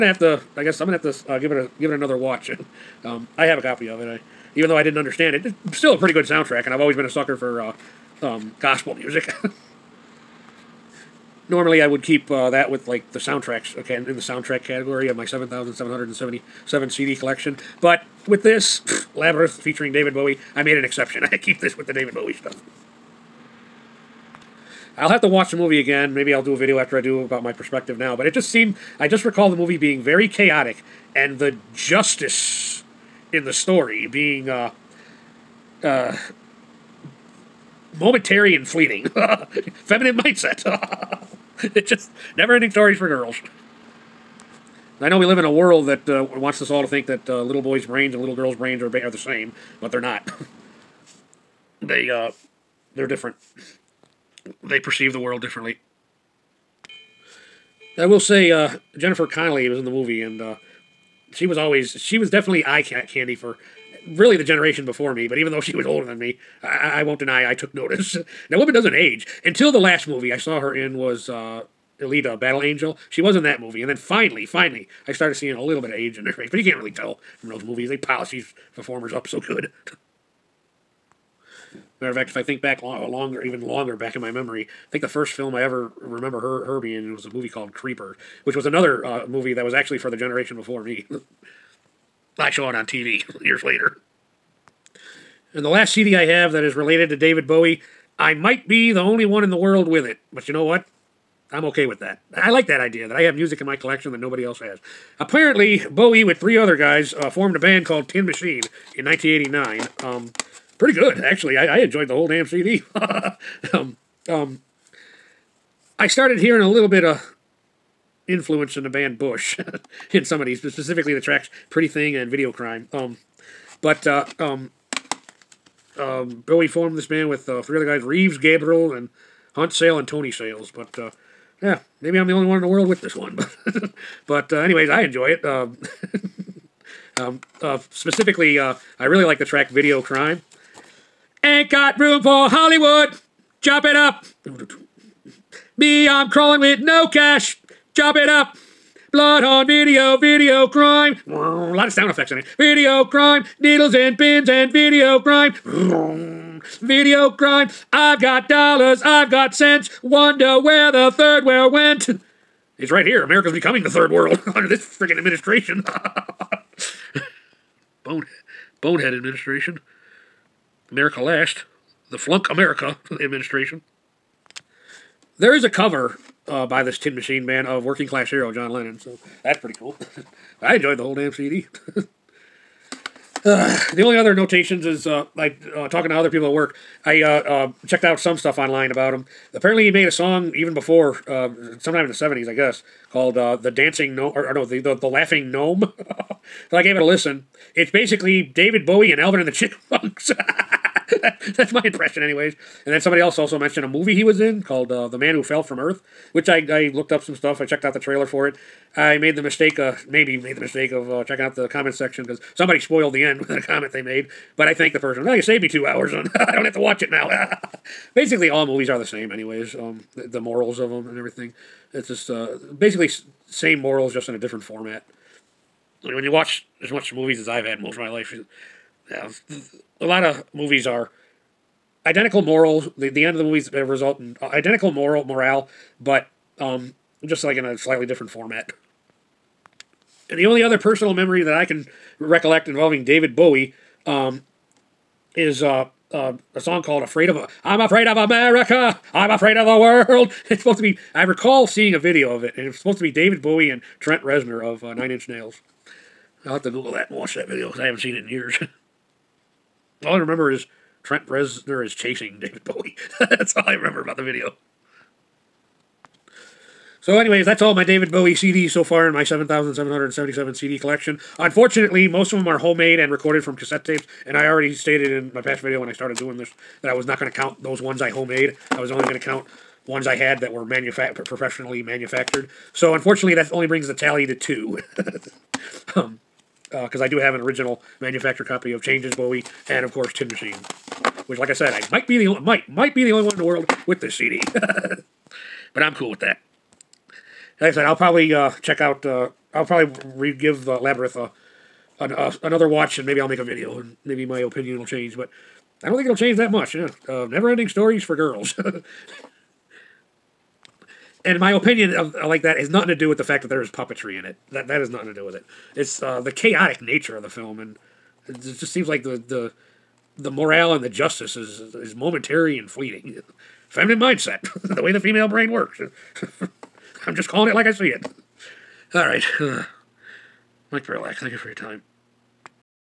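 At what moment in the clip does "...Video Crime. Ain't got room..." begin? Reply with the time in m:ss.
2:19.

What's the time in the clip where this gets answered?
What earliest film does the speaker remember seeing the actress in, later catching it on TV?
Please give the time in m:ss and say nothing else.
1:27.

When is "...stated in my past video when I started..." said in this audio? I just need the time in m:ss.
4:34.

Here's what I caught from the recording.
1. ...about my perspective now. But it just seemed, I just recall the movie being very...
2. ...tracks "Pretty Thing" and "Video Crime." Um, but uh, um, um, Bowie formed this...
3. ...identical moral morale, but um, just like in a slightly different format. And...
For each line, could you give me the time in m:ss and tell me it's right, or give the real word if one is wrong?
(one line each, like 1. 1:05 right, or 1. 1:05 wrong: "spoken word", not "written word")
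1. 0:27 right
2. 2:01 right
3. 3:54 right.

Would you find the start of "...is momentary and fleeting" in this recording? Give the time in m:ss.
5:21.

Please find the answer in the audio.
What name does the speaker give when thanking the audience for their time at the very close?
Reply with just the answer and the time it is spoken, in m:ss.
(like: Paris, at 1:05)
Mike Parylak, at 5:30.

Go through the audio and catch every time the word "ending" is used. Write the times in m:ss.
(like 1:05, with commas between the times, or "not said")
0:42, 5:07.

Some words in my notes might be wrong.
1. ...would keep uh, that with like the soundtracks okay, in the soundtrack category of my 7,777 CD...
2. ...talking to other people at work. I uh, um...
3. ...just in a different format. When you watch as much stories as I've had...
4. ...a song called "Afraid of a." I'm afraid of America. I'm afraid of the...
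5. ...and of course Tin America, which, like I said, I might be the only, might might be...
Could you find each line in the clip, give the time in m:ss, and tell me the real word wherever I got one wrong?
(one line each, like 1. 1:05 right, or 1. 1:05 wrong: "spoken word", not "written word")
1. 0:11 right
2. 3:05 right
3. 3:44 wrong: "movies", not "stories"
4. 4:06 right
5. 4:49 wrong: "Machine", not "America".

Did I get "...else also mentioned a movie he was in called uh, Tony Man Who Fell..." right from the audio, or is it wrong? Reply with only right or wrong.
wrong.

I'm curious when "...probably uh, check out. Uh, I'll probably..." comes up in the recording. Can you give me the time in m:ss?
4:57.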